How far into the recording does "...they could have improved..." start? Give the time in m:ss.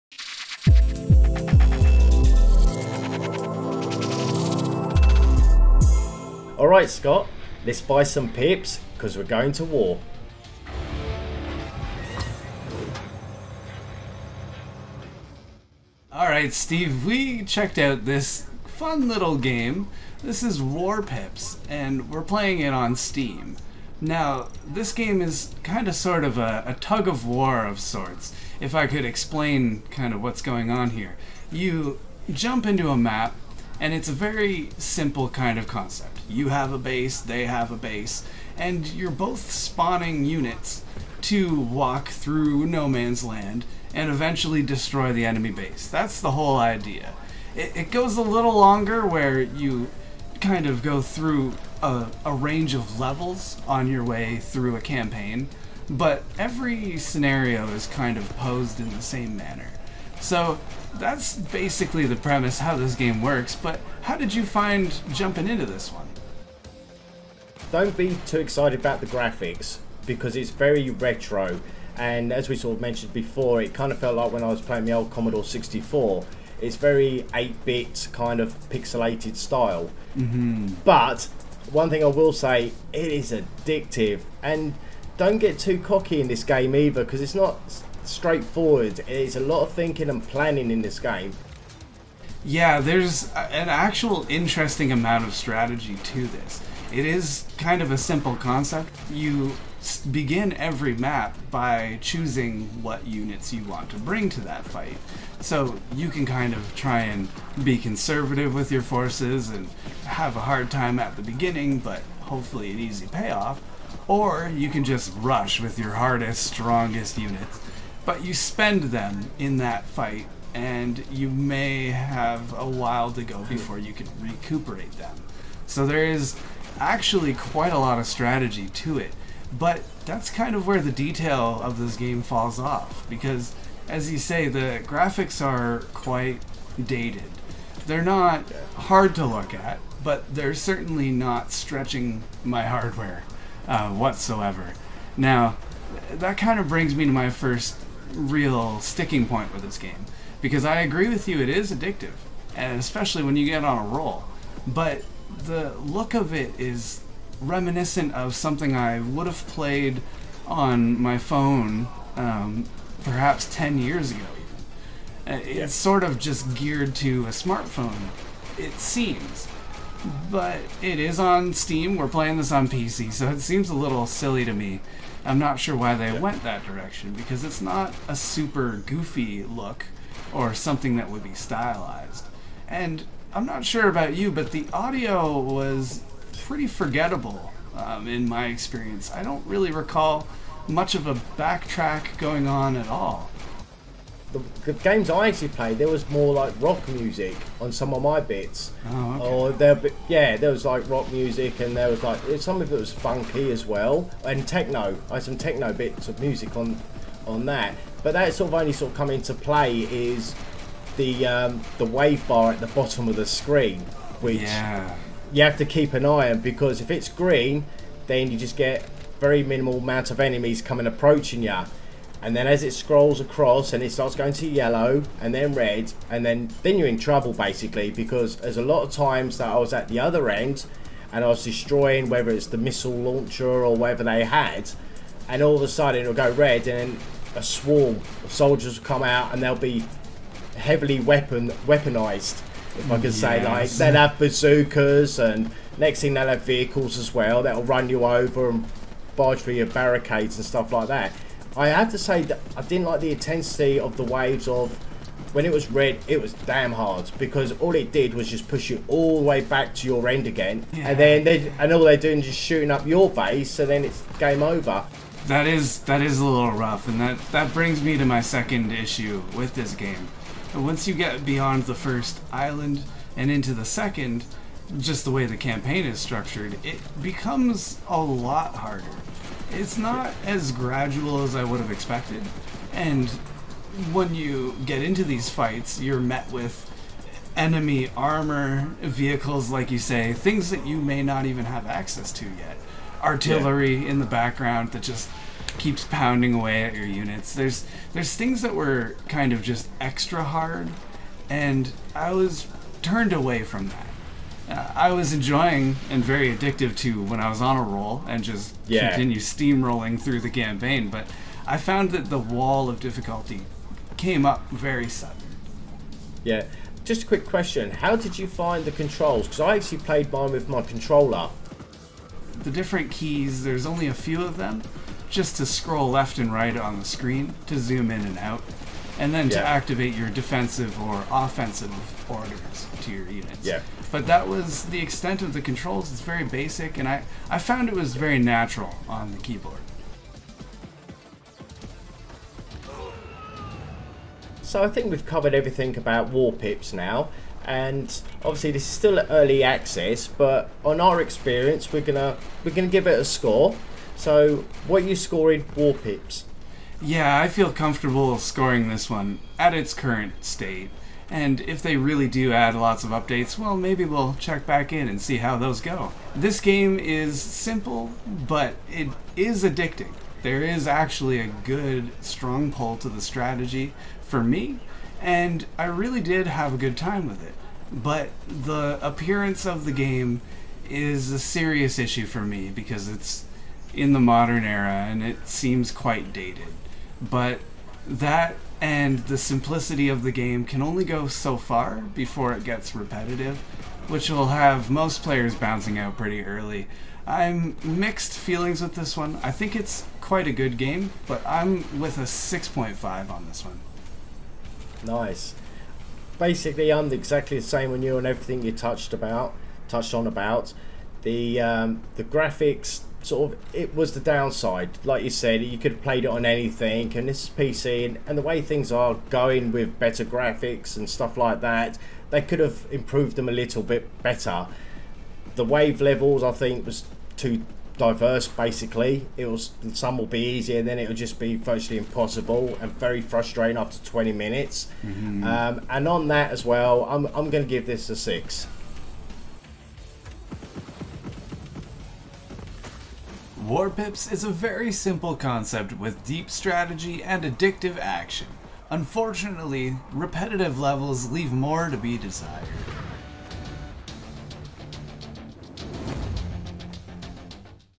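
7:02.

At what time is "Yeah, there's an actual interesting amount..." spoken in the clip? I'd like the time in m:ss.
1:32.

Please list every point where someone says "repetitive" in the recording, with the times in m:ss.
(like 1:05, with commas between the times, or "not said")
6:32, 7:29.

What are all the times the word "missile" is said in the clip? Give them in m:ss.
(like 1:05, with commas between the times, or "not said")
3:52.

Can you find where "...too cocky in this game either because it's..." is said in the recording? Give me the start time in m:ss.
1:25.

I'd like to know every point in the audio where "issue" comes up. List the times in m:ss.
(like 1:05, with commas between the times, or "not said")
4:28, 6:21.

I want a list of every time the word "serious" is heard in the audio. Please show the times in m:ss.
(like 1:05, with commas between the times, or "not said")
6:21.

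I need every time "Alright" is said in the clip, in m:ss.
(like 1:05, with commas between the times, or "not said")
0:06, 0:16.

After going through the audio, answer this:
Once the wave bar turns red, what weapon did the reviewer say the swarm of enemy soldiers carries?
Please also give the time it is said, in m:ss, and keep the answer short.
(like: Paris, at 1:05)
bazookas, at 4:04.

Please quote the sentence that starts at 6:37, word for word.
I'm mixed feelings with this one.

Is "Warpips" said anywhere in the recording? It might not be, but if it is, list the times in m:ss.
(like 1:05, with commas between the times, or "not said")
0:20, 5:46, 5:55, 7:23.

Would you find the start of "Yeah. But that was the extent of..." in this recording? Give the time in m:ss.
5:33.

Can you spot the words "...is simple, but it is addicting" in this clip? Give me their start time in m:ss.
6:06.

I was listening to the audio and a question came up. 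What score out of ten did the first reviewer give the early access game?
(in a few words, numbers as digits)
6.5.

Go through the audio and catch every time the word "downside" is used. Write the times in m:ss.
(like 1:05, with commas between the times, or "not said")
6:53.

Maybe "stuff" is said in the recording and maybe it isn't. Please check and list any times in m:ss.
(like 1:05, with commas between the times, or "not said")
4:10, 7:00.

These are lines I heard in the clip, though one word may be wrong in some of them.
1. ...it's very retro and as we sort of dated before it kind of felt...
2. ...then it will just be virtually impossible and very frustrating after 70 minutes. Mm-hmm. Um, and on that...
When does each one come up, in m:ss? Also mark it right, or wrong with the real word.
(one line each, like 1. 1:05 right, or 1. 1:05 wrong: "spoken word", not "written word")
1. 1:10 wrong: "mentioned", not "dated"
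2. 7:10 wrong: "20", not "70".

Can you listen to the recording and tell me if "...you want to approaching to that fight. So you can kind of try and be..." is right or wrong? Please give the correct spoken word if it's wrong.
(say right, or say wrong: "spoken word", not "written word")
wrong: "bring", not "approaching".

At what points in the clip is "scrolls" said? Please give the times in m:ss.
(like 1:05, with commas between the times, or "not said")
3:42, 5:25.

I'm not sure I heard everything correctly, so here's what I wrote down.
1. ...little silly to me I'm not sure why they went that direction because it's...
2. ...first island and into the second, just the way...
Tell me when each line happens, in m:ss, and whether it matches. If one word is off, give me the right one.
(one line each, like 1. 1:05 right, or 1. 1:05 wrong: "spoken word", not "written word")
1. 2:53 right
2. 4:31 right.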